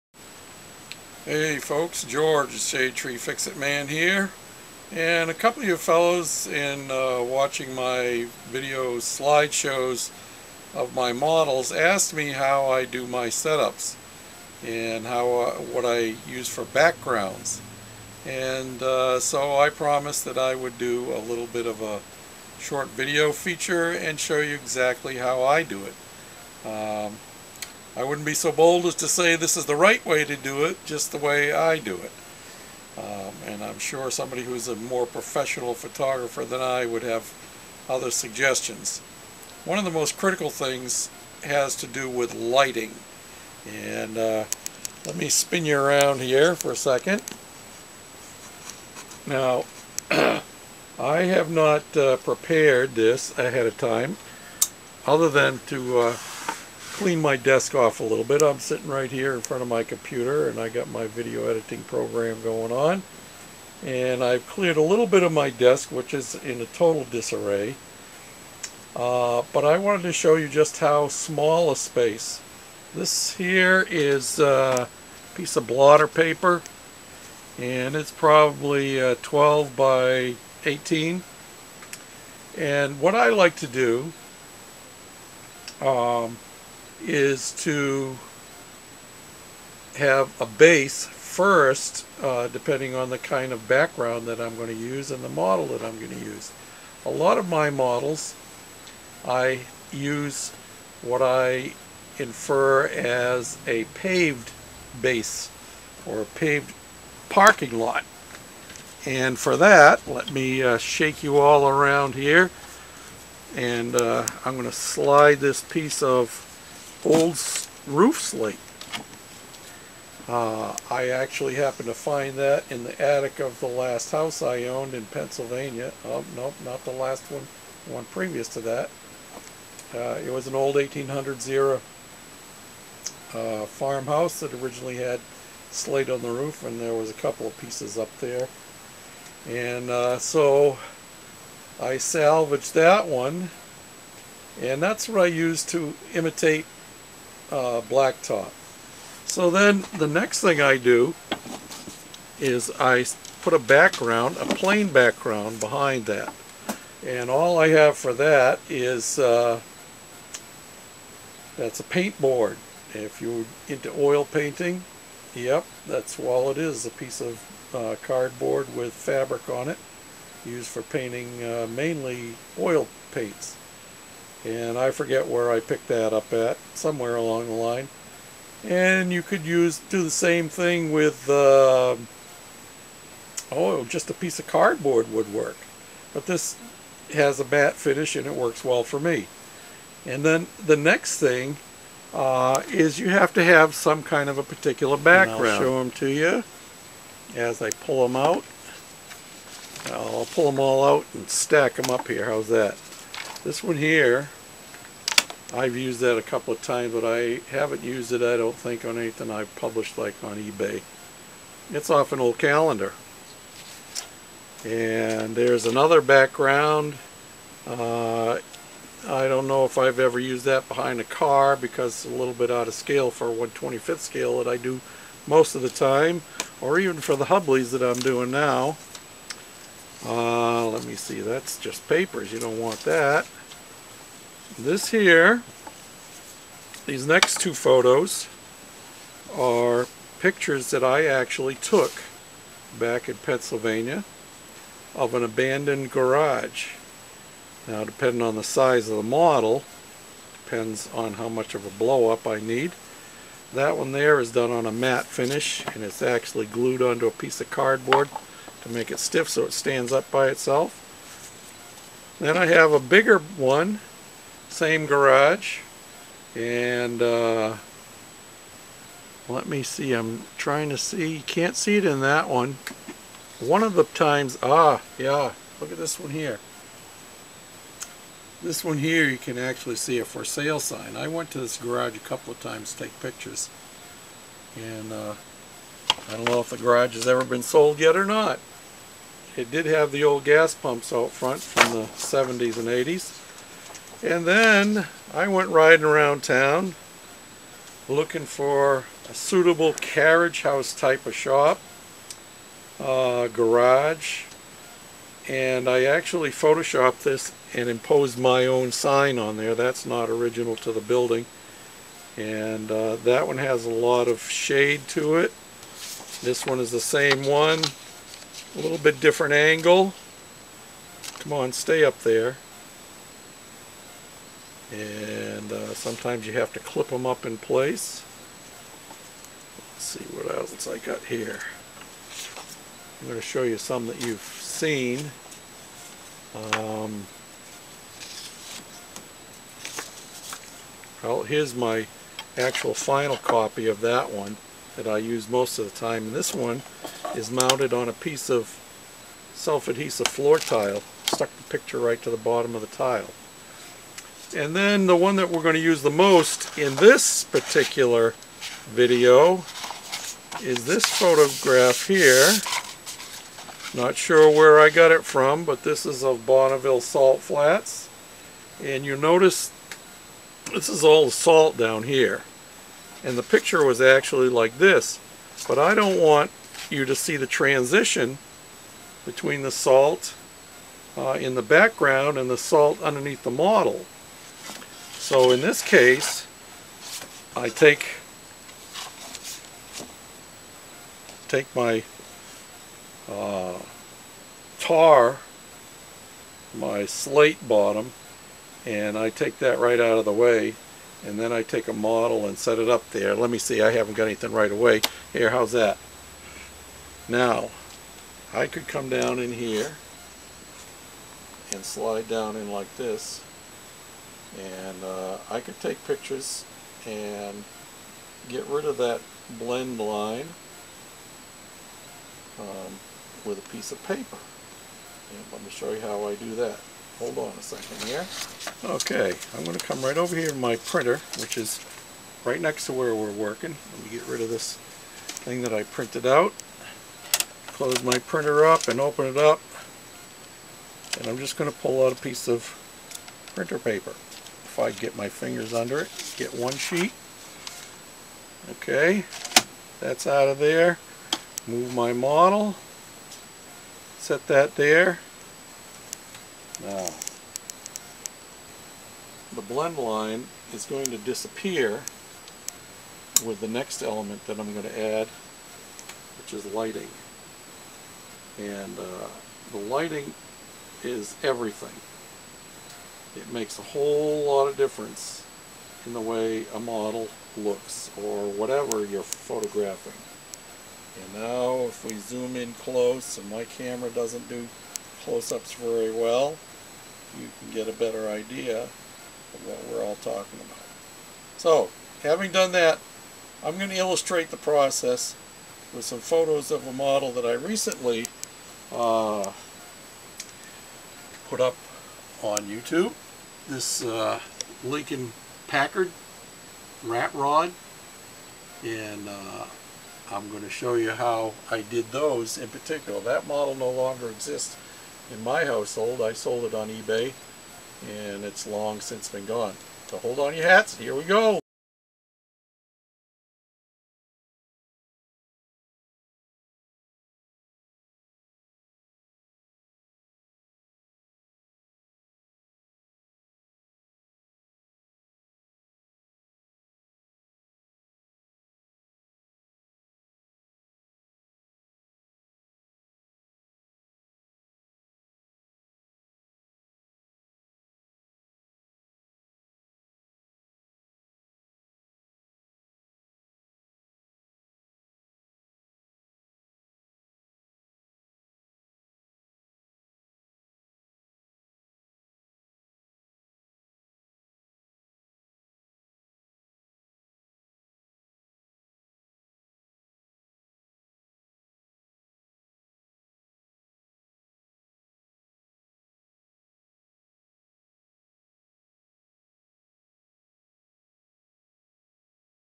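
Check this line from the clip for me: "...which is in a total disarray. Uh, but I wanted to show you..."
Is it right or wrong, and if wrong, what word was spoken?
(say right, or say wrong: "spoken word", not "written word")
right.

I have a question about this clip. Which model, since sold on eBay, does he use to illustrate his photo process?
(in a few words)
Lincoln Packard rat rod.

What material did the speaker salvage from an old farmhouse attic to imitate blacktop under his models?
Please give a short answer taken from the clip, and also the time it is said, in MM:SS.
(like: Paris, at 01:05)
roof slate, at 01:57.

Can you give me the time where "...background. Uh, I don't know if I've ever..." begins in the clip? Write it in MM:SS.
03:36.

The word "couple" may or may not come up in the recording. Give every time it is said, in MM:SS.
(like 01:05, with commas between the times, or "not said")
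00:05, 02:17, 03:26, 04:41.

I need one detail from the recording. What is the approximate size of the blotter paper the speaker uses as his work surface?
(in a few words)
12 by 18.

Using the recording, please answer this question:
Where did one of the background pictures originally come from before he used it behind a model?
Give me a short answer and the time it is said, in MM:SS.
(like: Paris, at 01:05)
an old calendar, at 03:32.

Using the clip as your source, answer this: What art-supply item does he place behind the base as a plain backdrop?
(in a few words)
paint board.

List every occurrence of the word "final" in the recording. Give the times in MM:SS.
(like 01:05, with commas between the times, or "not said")
05:42.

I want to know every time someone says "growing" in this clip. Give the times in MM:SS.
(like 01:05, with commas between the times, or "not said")
not said.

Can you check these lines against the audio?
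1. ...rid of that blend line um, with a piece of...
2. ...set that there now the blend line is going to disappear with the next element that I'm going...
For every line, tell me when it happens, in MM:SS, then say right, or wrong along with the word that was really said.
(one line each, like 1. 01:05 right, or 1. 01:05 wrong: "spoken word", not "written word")
1. 06:58 right
2. 07:33 right.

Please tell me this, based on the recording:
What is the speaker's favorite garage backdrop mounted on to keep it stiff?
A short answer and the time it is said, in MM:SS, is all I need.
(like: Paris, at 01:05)
self-adhesive floor tile, at 05:49.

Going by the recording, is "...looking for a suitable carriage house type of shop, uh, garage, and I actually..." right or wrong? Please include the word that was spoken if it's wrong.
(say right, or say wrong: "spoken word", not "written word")
right.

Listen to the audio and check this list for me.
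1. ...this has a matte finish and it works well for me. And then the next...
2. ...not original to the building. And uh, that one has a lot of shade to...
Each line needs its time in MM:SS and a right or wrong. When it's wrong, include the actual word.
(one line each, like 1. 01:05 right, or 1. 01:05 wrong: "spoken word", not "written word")
1. 03:06 right
2. 05:09 right.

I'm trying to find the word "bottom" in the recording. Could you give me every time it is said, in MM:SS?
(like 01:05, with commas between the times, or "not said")
05:52, 06:37.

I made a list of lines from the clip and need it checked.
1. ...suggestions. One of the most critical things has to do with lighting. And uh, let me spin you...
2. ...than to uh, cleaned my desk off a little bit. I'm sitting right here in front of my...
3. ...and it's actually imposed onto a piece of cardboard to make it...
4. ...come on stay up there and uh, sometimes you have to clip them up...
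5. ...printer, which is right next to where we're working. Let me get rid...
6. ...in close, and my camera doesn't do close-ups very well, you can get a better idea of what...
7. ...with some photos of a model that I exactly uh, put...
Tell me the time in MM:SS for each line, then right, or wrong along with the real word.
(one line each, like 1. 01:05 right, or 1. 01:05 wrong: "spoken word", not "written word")
1. 00:38 right
2. 00:55 right
3. 04:15 wrong: "glued", not "imposed"
4. 05:21 right
5. 07:10 right
6. 08:02 right
7. 08:15 wrong: "recently", not "exactly".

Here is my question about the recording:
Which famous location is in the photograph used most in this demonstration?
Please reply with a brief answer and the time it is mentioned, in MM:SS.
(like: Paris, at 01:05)
Bonneville Salt Flats, at 06:06.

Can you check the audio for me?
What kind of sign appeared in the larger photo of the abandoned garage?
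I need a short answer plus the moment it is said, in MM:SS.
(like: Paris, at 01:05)
for sale sign, at 04:40.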